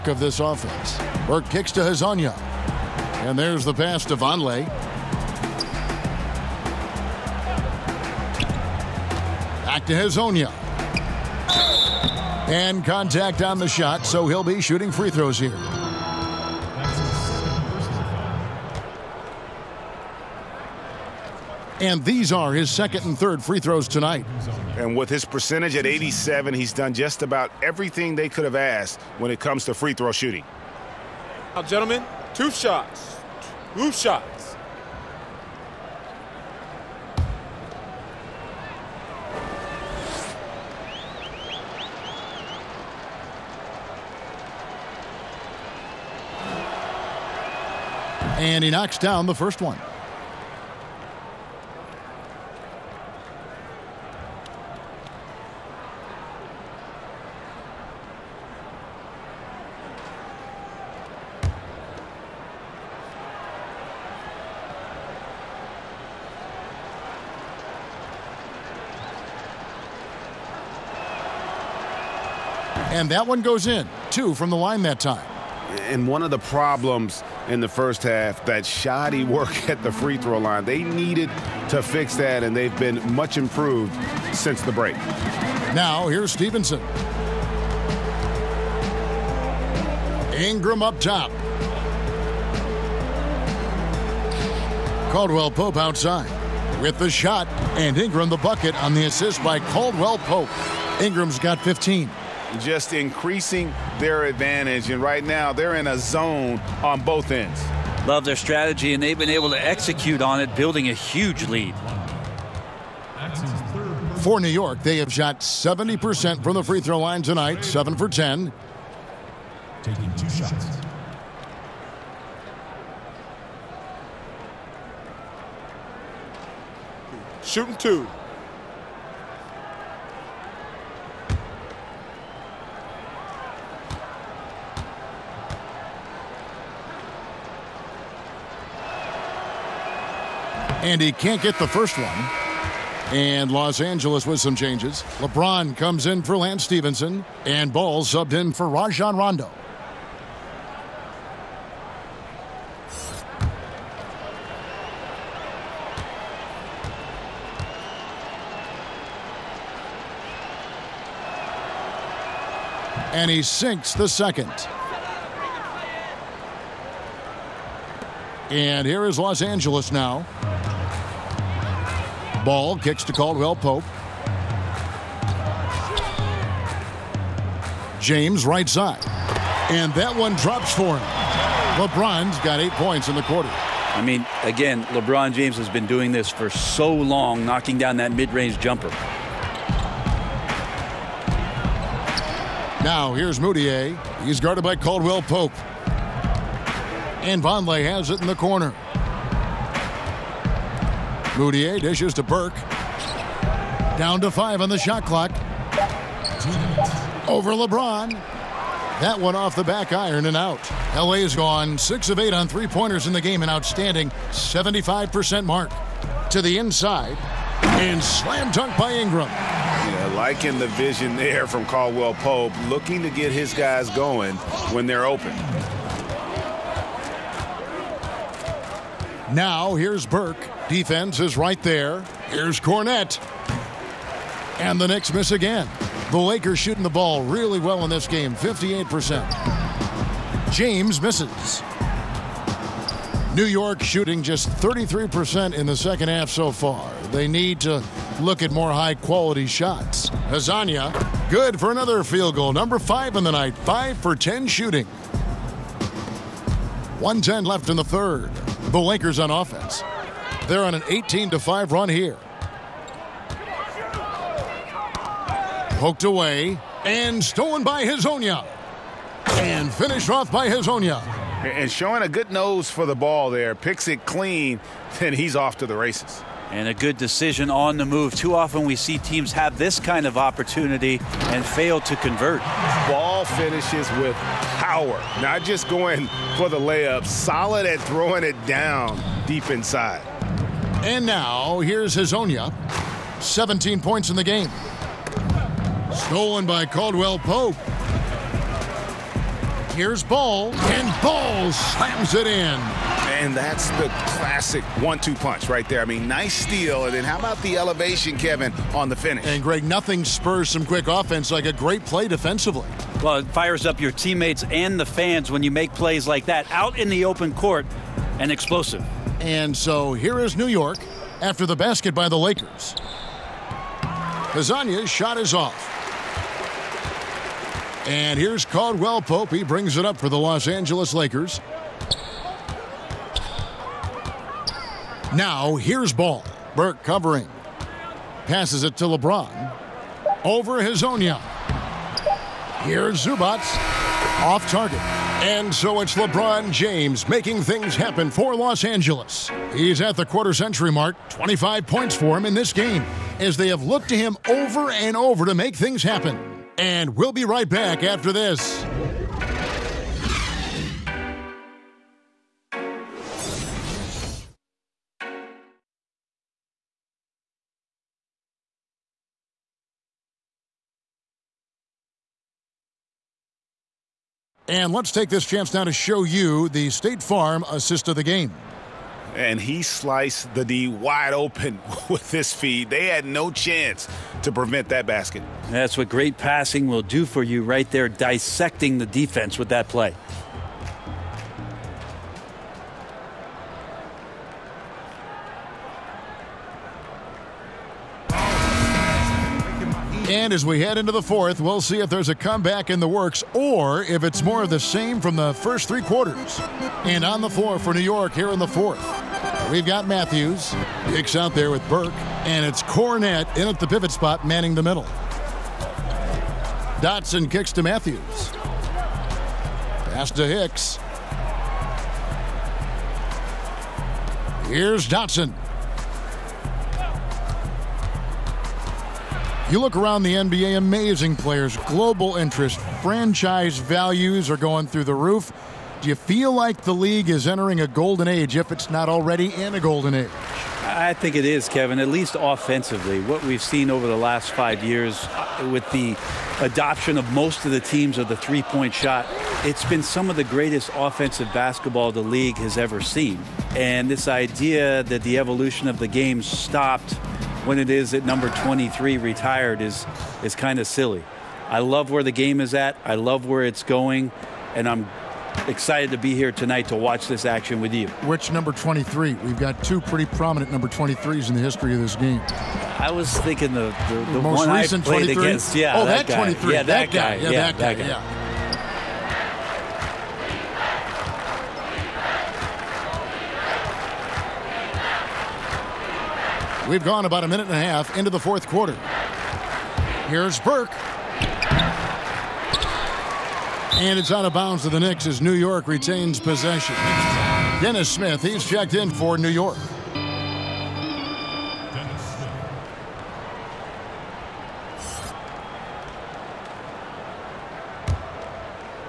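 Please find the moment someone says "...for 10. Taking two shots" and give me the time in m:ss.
1:57.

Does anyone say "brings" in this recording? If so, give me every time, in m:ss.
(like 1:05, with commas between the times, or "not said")
5:29.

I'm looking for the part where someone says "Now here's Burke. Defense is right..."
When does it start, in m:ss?
3:49.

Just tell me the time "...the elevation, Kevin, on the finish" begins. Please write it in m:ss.
5:07.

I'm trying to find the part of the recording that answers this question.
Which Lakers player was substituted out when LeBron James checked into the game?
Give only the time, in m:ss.
2:26.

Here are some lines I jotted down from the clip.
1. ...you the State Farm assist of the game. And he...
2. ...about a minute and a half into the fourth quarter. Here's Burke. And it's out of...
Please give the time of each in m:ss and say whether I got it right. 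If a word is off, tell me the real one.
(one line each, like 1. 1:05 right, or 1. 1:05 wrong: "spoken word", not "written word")
1. 6:16 right
2. 8:07 right.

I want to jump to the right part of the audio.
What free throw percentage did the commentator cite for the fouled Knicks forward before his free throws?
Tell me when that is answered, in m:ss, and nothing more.
0:25.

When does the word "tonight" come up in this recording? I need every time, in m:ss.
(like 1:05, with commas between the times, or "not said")
0:23, 1:57, 7:46.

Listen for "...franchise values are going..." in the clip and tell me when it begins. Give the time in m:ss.
7:12.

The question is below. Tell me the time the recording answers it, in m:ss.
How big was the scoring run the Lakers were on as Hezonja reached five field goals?
4:20.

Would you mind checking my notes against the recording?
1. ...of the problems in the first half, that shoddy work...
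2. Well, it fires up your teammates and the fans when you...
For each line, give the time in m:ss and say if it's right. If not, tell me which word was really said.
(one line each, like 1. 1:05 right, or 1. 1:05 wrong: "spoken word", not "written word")
1. 1:16 right
2. 5:13 right.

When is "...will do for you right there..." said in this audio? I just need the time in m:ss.
6:26.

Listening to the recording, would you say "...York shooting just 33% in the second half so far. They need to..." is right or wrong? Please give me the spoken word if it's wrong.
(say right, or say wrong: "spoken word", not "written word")
right.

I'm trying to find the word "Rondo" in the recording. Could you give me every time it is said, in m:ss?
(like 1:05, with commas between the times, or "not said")
2:29.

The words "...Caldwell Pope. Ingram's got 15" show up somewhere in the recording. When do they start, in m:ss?
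1:39.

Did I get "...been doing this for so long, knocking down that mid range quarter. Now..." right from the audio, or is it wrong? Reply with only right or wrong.
wrong.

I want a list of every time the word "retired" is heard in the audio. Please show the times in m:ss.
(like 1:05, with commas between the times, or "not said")
7:38.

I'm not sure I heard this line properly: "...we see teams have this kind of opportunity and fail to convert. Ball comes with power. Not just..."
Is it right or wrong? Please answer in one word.
wrong.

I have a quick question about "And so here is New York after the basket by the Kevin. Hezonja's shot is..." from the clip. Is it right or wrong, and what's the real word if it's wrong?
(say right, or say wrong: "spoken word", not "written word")
wrong: "Lakers", not "Kevin".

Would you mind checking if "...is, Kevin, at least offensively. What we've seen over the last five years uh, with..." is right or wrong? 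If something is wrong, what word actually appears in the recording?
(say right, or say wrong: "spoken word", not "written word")
right.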